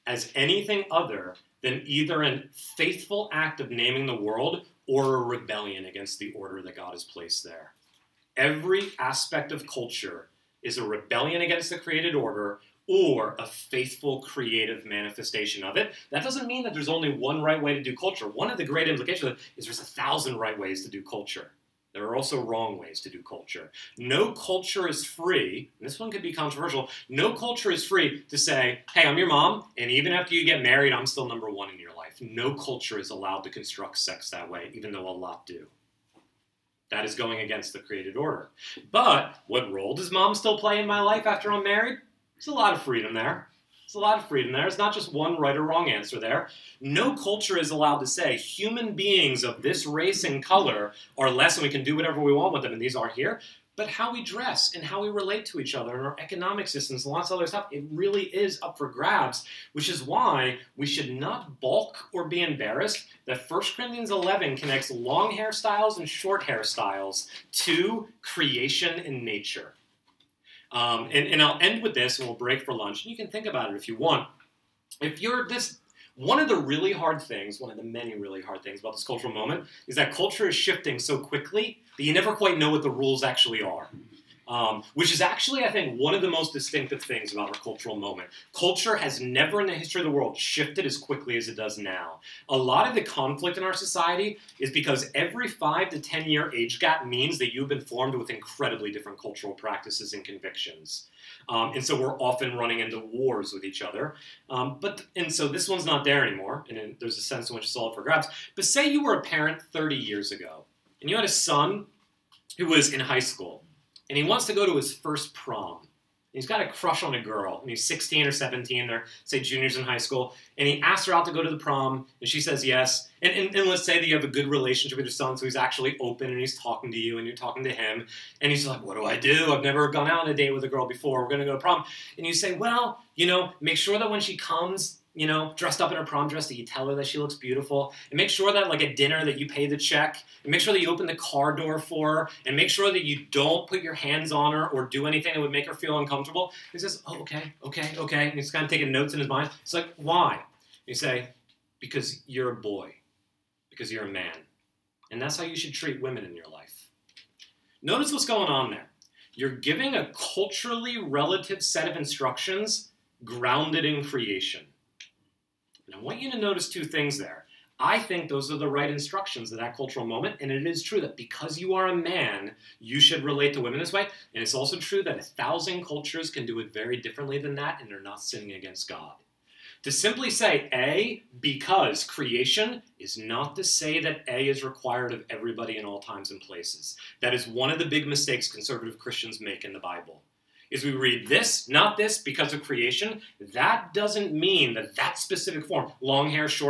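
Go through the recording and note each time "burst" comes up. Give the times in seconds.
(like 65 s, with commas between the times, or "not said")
not said.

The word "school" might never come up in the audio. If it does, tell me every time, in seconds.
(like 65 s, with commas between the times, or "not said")
113 s, 119 s.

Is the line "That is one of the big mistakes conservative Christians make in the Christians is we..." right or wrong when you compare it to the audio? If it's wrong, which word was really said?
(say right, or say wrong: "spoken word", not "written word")
wrong: "Bible", not "Christians".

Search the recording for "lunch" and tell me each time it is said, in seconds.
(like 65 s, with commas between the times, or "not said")
72 s.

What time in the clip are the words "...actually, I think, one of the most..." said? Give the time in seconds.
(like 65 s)
85 s.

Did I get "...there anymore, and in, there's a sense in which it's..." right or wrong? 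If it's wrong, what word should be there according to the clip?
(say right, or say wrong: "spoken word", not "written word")
right.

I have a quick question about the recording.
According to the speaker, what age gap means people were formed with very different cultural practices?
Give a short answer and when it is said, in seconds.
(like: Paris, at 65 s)
5 to 10, at 95 s.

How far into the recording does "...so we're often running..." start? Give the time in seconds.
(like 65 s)
101 s.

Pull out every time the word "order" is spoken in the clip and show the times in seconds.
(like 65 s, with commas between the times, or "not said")
6 s, 12 s, 38 s.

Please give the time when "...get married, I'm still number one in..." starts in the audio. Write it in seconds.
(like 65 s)
30 s.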